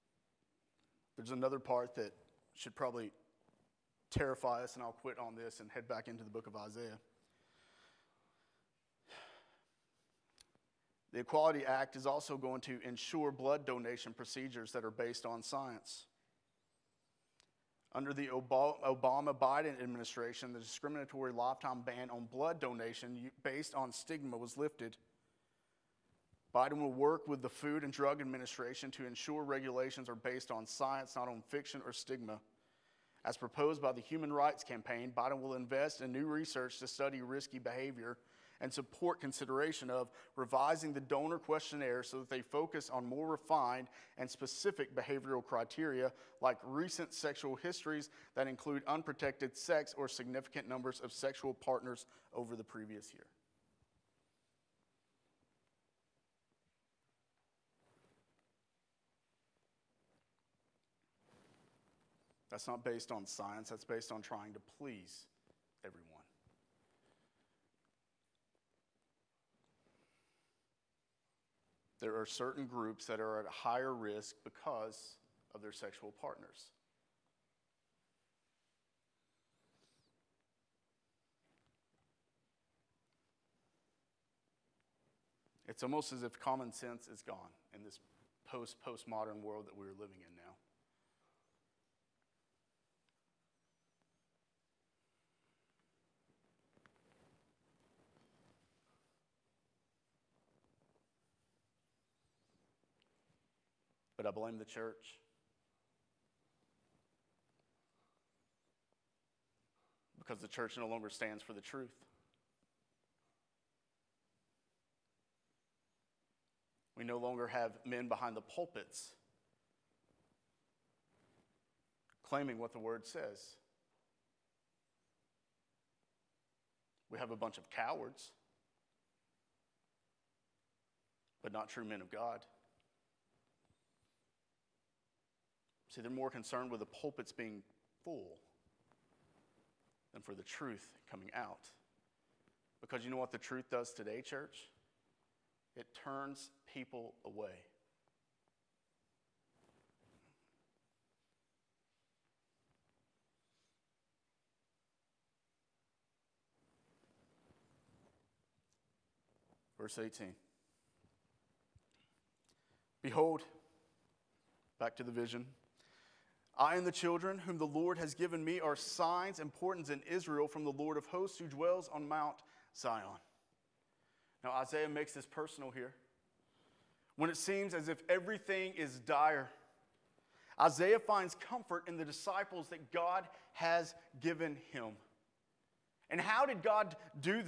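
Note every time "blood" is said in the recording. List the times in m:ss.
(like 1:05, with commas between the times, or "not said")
0:13, 0:22.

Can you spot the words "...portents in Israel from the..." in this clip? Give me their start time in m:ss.
2:49.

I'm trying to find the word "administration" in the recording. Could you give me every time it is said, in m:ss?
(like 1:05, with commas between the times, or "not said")
0:19, 0:28.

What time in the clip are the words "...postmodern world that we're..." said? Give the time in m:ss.
1:28.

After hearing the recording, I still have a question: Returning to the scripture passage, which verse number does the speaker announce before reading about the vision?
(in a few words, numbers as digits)
18.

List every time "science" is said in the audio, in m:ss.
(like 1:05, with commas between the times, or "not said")
0:15, 0:30, 1:03.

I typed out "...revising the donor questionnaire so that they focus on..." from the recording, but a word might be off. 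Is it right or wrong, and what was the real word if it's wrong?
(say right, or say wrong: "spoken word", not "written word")
right.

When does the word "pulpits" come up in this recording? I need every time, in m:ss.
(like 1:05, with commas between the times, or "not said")
1:58, 2:16.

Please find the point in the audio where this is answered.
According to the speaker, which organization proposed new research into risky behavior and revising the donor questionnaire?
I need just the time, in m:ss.
0:34.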